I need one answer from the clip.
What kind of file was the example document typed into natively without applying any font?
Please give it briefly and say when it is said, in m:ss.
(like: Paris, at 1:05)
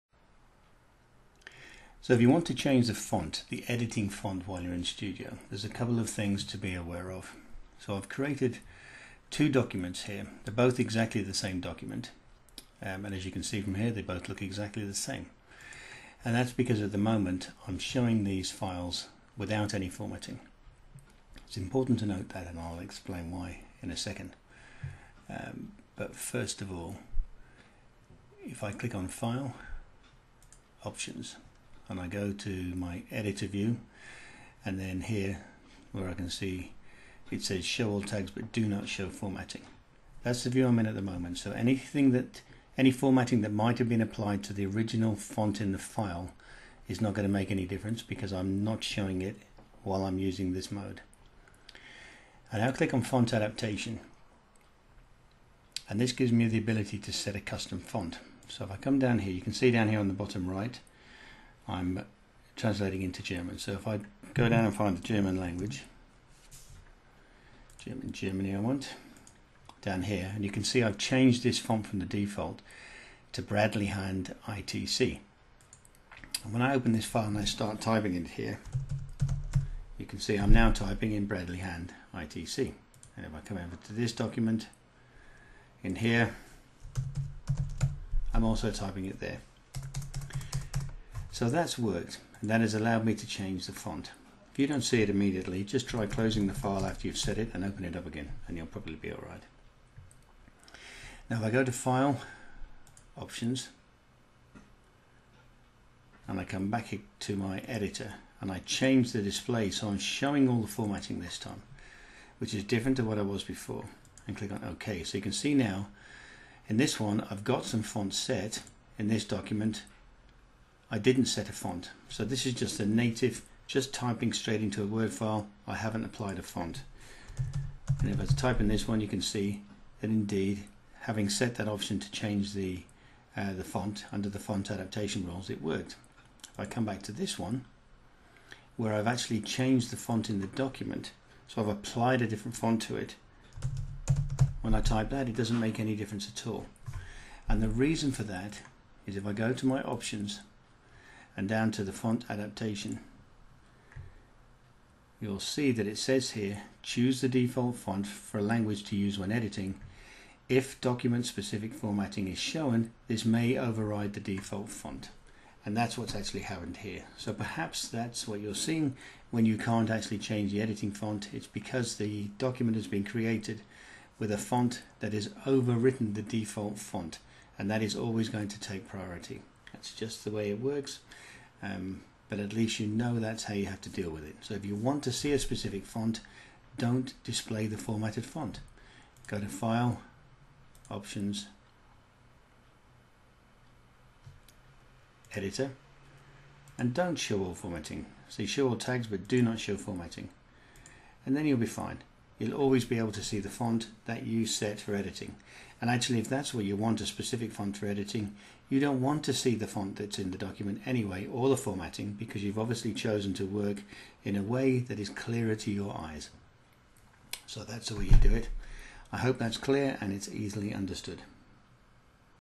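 Word file, at 2:04.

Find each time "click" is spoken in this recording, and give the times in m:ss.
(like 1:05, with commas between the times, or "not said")
0:28, 0:52, 1:54.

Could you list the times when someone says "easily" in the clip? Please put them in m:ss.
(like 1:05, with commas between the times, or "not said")
3:40.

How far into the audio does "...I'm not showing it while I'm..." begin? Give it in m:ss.
0:48.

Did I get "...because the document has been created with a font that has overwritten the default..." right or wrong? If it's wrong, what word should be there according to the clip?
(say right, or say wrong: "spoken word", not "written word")
right.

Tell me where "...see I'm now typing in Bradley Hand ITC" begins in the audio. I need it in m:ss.
1:20.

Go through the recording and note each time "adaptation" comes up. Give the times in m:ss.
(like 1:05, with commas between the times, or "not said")
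0:53, 2:14, 2:32.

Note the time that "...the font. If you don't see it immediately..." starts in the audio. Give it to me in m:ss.
1:33.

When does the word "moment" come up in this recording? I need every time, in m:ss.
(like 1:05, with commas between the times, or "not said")
0:16, 0:41.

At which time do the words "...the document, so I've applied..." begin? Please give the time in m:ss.
2:20.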